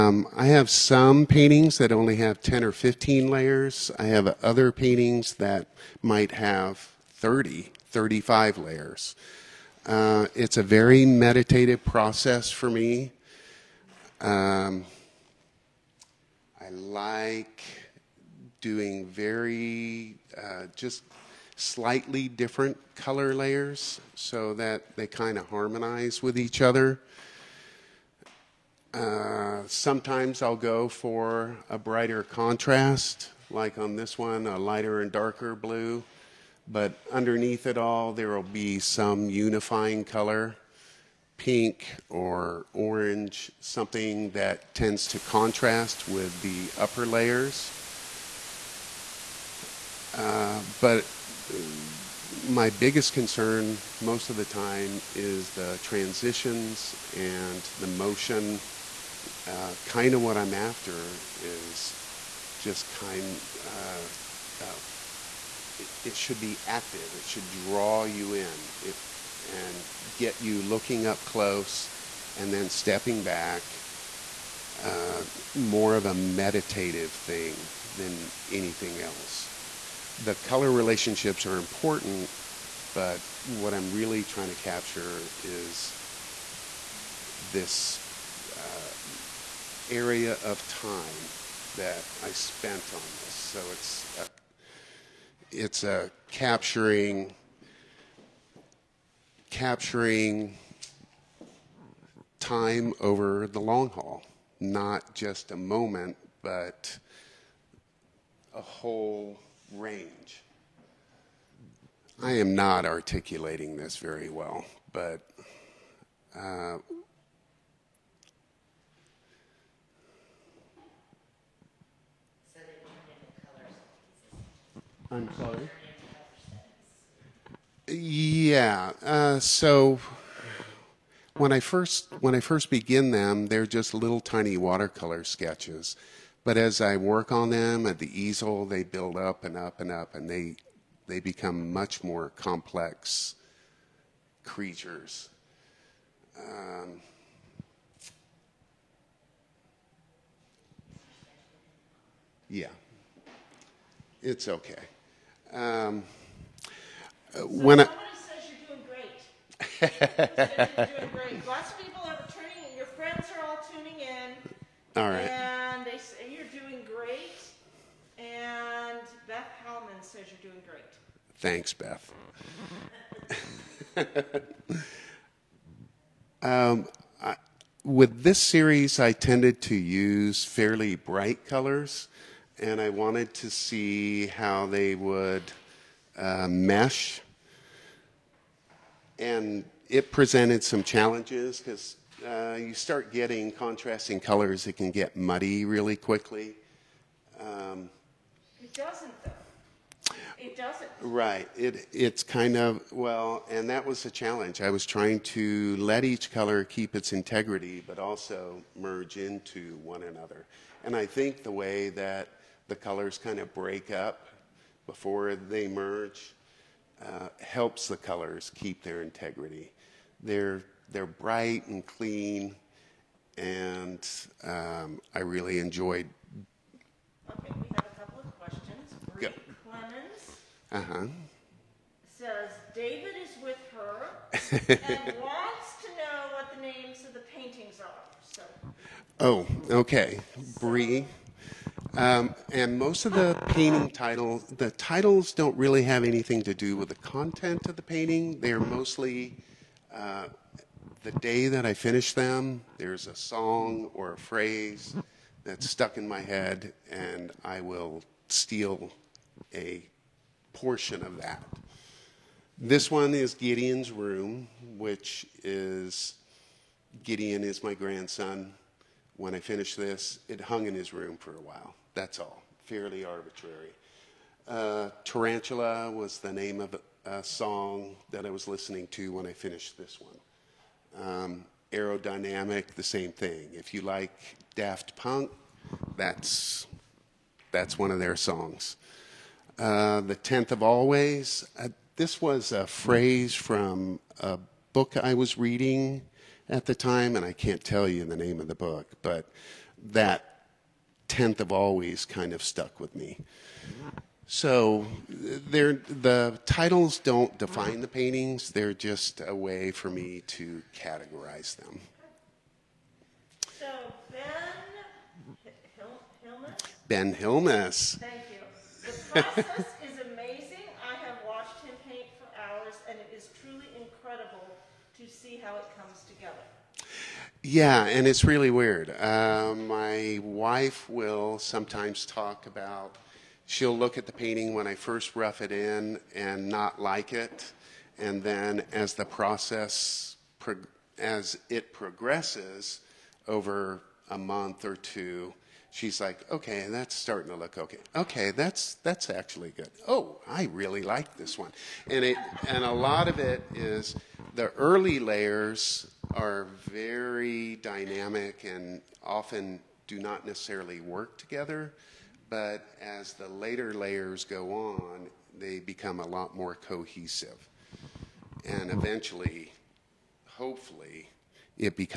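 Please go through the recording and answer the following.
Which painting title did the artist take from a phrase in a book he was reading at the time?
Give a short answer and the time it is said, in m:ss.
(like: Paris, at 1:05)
The Tenth of Always, at 4:50.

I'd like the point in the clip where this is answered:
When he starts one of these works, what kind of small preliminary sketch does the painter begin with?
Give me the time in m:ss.
2:14.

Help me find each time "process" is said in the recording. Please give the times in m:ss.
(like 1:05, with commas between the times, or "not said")
0:11, 5:19, 5:39.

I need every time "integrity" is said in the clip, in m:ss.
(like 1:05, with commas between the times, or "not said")
3:27, 3:39.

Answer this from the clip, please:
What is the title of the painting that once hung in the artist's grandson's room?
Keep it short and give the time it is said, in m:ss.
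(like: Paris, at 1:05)
Gideon's Room, at 4:23.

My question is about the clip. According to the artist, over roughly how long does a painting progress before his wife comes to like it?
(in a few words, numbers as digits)
a month or two.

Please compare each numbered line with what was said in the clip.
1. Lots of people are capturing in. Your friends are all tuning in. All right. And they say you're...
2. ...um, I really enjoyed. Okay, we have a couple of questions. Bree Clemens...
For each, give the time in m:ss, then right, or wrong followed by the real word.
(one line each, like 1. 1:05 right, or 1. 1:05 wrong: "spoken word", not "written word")
1. 2:41 wrong: "tuning", not "capturing"
2. 3:44 right.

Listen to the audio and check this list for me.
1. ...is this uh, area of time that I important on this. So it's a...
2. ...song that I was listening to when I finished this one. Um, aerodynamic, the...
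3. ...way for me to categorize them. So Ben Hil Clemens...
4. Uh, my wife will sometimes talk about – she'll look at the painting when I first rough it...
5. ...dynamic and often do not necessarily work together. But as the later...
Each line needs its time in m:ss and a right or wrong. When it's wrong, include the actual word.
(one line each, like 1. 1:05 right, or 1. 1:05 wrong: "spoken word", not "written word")
1. 1:25 wrong: "spent", not "important"
2. 4:37 right
3. 5:09 wrong: "Ben", not "Clemens"
4. 5:28 right
5. 5:57 right.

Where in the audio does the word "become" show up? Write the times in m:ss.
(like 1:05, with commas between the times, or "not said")
2:21, 6:05.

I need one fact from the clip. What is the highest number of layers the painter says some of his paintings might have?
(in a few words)
35.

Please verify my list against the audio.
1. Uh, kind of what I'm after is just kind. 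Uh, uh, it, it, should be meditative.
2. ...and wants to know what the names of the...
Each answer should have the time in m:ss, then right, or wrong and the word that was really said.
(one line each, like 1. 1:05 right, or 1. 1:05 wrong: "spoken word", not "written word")
1. 0:59 wrong: "active", not "meditative"
2. 3:54 right.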